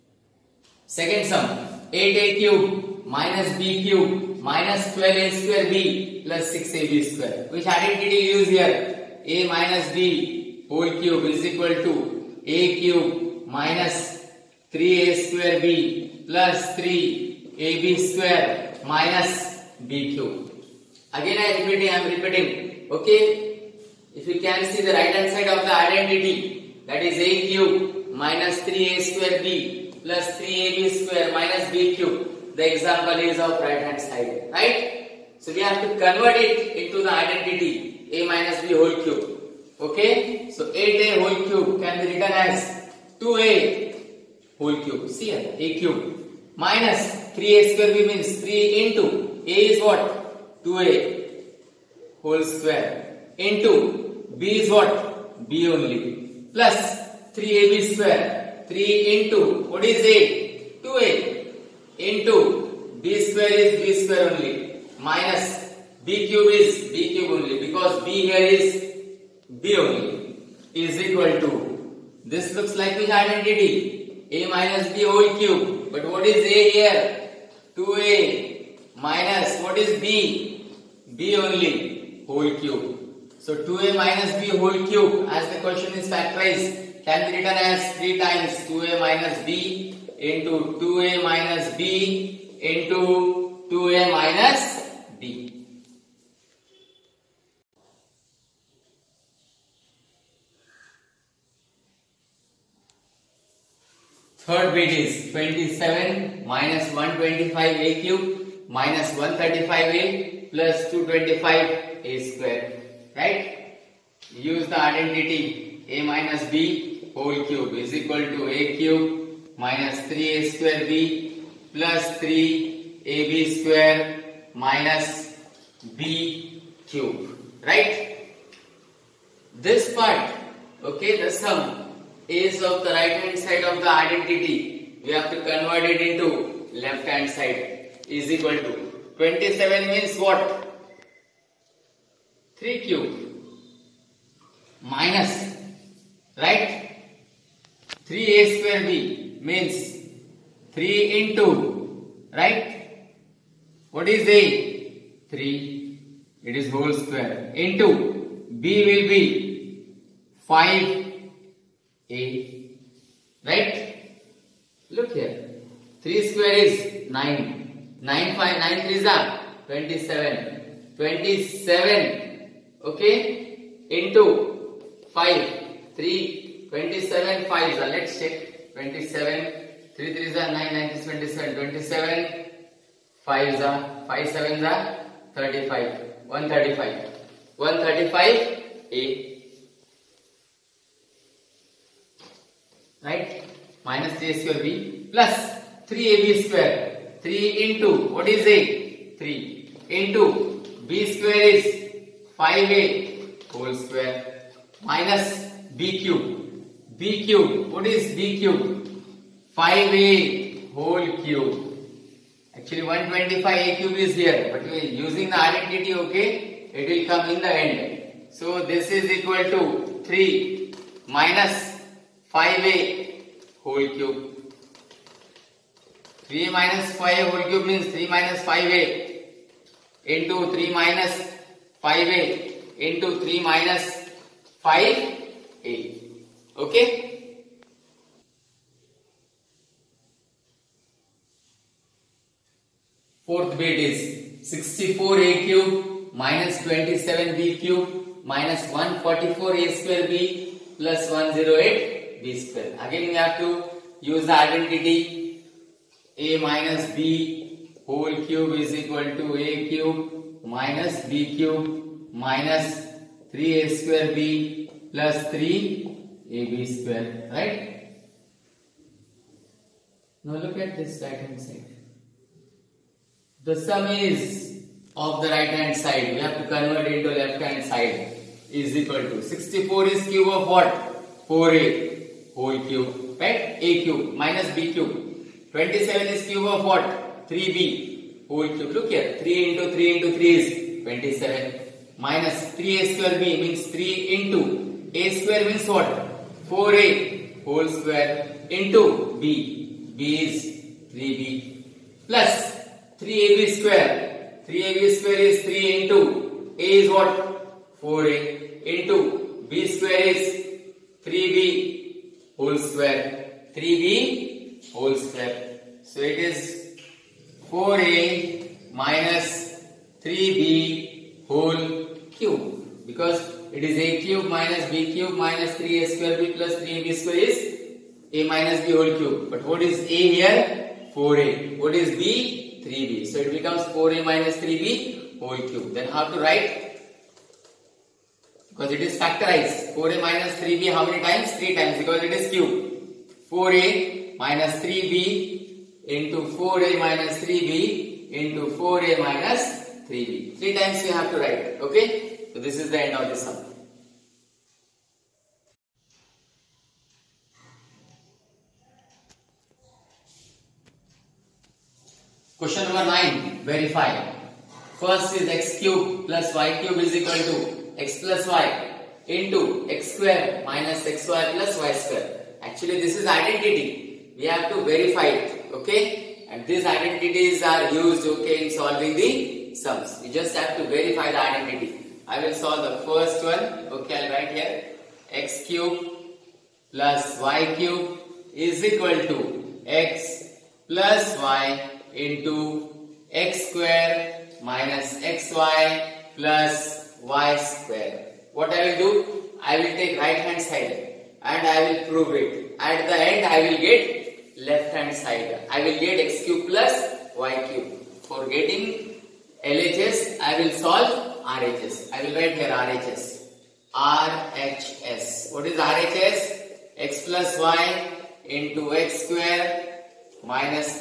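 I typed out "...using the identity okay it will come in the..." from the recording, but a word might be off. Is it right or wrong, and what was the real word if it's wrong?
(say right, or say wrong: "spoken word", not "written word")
right.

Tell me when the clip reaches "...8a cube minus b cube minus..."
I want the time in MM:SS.
00:01.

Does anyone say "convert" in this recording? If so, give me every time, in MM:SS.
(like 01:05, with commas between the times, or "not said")
00:36, 02:15, 04:36.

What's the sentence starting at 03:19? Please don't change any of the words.
3 into b square is 5a whole square minus b cube.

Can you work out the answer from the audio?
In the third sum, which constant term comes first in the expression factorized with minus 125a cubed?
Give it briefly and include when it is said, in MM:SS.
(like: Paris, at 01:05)
27, at 01:45.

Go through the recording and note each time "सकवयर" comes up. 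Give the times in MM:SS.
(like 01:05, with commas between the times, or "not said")
04:09.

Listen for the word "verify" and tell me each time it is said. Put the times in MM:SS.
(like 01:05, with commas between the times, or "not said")
06:03, 06:14, 06:20.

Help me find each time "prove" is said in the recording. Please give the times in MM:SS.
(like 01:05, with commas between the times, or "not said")
06:41.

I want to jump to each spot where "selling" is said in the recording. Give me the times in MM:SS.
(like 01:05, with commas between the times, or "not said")
not said.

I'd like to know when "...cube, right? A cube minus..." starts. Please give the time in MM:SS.
04:42.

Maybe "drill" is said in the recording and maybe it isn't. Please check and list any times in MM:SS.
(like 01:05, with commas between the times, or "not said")
not said.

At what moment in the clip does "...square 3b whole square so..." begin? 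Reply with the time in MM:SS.
05:12.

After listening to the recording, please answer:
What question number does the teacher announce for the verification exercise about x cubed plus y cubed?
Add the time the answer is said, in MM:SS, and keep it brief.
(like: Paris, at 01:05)
9, at 06:02.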